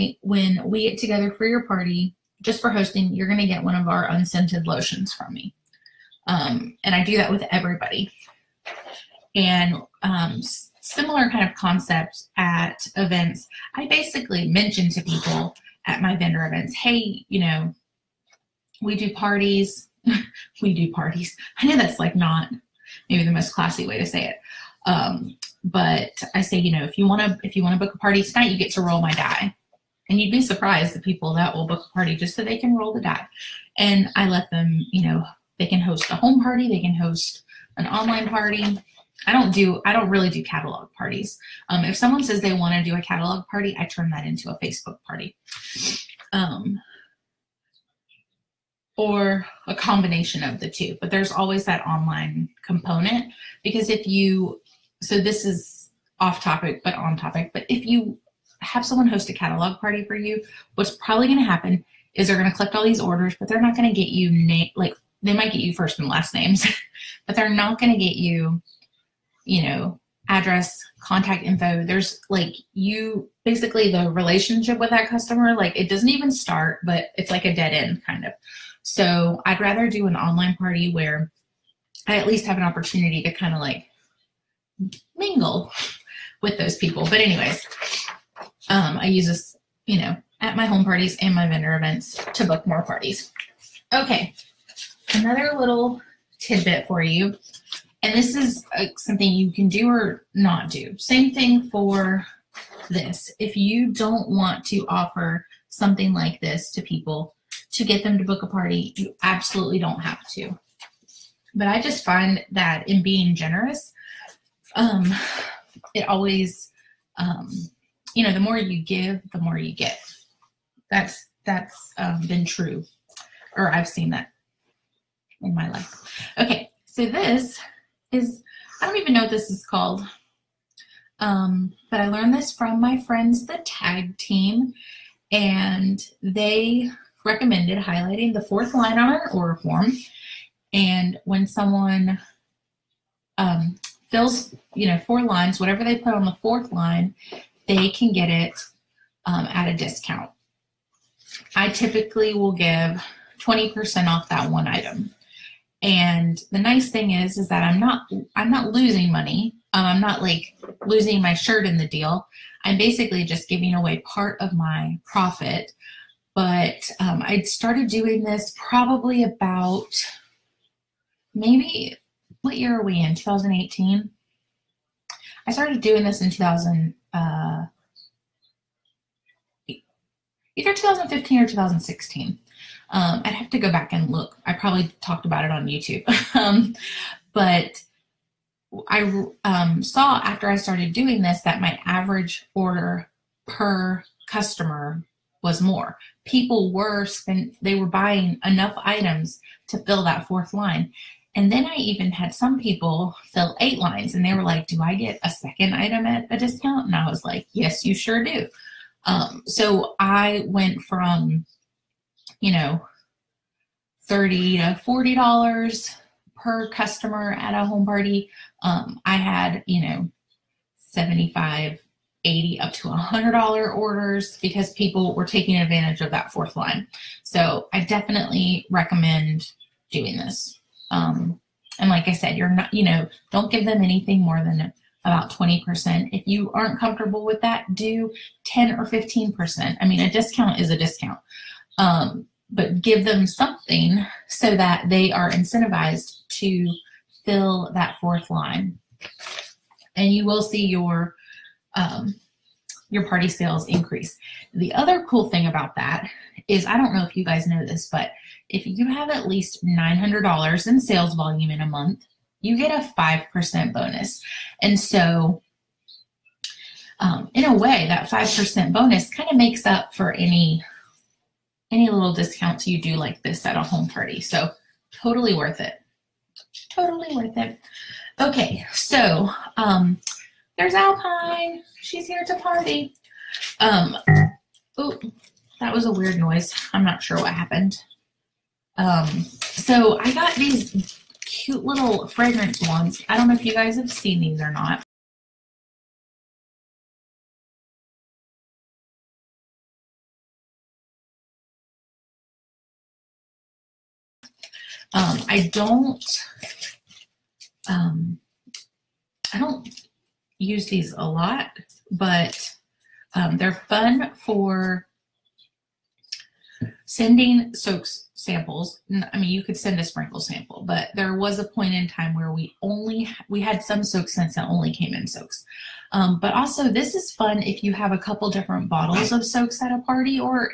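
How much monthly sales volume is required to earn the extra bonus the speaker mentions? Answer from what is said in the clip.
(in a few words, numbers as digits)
$900.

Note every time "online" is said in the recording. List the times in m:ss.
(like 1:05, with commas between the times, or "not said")
0:37, 0:51, 1:20.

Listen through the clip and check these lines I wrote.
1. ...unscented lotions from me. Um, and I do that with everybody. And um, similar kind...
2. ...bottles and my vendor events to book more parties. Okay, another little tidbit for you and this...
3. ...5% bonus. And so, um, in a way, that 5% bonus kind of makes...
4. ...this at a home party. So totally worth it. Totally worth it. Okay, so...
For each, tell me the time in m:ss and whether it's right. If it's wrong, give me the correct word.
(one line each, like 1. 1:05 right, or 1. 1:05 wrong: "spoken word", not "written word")
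1. 0:04 right
2. 1:30 wrong: "parties", not "bottles"
3. 4:22 right
4. 4:33 right.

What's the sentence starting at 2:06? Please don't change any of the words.
Okay, so this is, I don't even know what this is called.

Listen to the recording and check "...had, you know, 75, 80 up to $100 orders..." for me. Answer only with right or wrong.
right.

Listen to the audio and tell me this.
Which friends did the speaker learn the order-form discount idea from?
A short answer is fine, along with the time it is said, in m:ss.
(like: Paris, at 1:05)
the tag team, at 2:13.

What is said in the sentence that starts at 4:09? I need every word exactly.
And you will see your um, your party sales increase.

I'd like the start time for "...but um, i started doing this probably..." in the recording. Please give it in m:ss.
2:46.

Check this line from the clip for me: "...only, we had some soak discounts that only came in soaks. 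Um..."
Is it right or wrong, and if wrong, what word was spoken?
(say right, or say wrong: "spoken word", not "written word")
wrong: "scents", not "discounts".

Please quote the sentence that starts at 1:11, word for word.
There's like you basically the relationship with that customer, like it doesn't even start, but it's like a dead end kind of.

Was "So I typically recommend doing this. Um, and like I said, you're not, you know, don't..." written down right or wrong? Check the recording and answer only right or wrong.
wrong.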